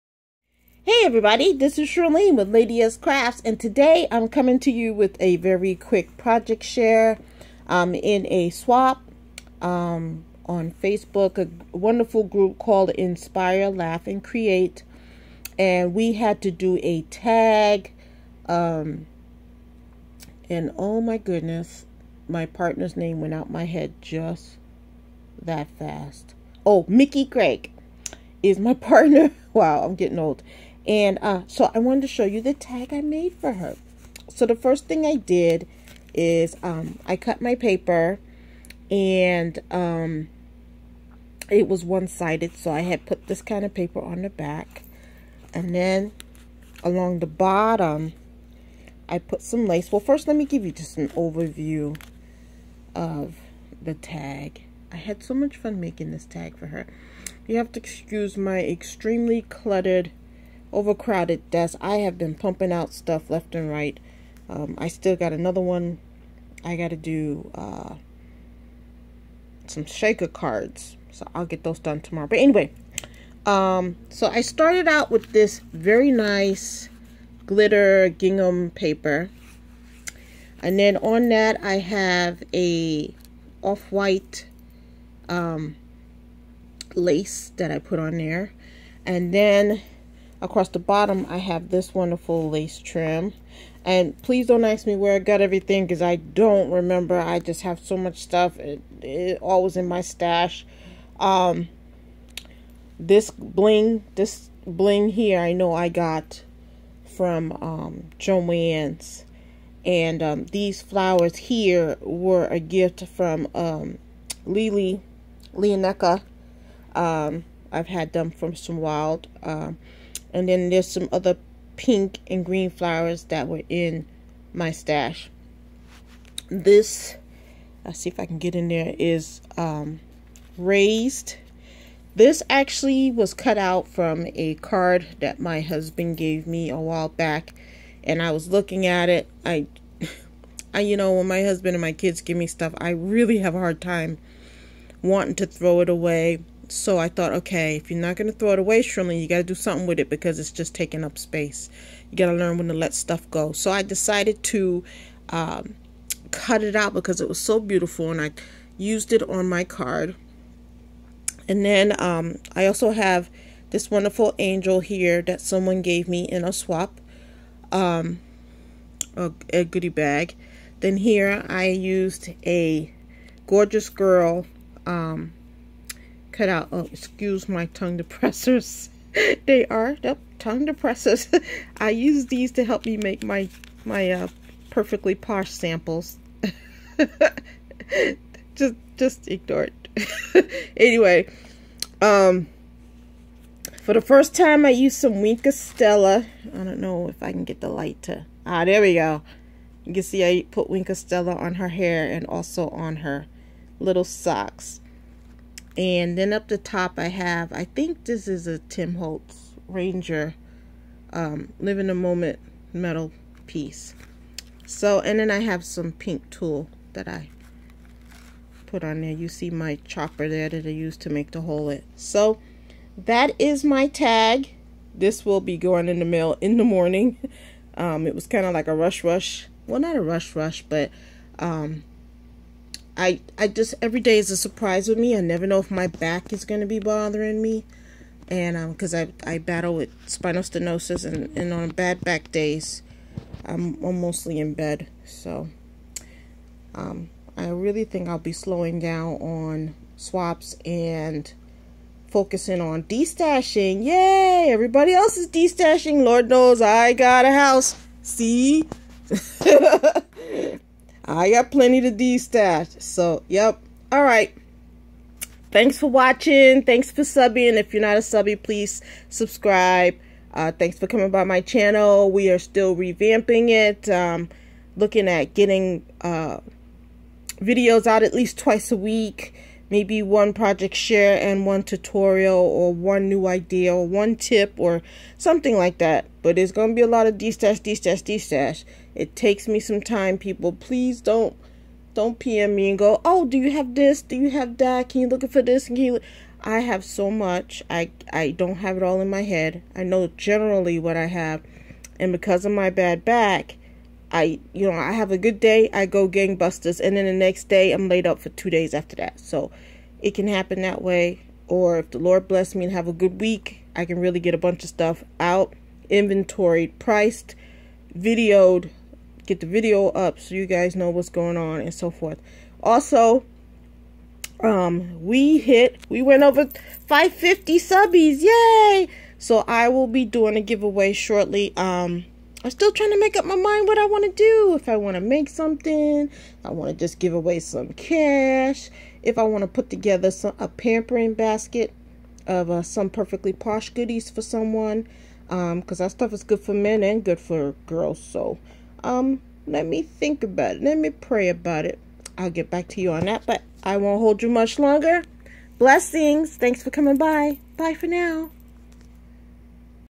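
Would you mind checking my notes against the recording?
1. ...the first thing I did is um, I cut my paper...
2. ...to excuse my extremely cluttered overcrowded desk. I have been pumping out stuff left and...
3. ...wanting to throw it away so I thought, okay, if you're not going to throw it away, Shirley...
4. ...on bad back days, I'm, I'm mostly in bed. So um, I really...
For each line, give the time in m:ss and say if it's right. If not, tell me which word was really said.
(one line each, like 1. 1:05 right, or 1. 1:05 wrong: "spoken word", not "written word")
1. 0:34 right
2. 0:57 right
3. 2:25 right
4. 4:01 right.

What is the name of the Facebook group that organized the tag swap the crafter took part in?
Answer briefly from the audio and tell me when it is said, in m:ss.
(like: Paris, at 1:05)
Inspire, Laugh and Create, at 0:12.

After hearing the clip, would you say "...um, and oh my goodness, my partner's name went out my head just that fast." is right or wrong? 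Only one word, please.
right.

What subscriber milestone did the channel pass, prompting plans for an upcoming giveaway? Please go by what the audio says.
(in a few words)
550.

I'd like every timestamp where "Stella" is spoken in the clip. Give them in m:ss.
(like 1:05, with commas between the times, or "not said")
3:15, 3:20.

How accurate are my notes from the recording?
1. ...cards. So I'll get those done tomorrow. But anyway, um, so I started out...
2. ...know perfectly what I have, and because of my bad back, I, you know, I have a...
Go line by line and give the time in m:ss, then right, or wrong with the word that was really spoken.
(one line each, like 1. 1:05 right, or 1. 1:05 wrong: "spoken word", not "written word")
1. 1:10 right
2. 4:59 wrong: "generally", not "perfectly".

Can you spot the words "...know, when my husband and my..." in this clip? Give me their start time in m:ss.
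2:20.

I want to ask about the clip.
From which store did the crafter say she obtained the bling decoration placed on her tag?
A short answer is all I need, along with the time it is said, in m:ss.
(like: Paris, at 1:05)
Joann's, at 1:48.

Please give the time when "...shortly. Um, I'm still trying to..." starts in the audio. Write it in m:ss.
5:30.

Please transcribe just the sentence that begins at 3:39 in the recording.
You see my chopper there that I used to make the hole in.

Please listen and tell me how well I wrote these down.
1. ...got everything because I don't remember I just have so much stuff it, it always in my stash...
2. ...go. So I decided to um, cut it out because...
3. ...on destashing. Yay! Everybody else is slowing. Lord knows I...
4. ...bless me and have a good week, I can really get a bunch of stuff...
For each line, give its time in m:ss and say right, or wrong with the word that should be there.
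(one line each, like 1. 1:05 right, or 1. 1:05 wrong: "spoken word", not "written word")
1. 1:35 right
2. 2:33 right
3. 4:12 wrong: "destashing", not "slowing"
4. 5:12 right.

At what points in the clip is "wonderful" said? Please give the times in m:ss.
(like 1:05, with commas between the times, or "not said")
0:11, 1:31, 2:43.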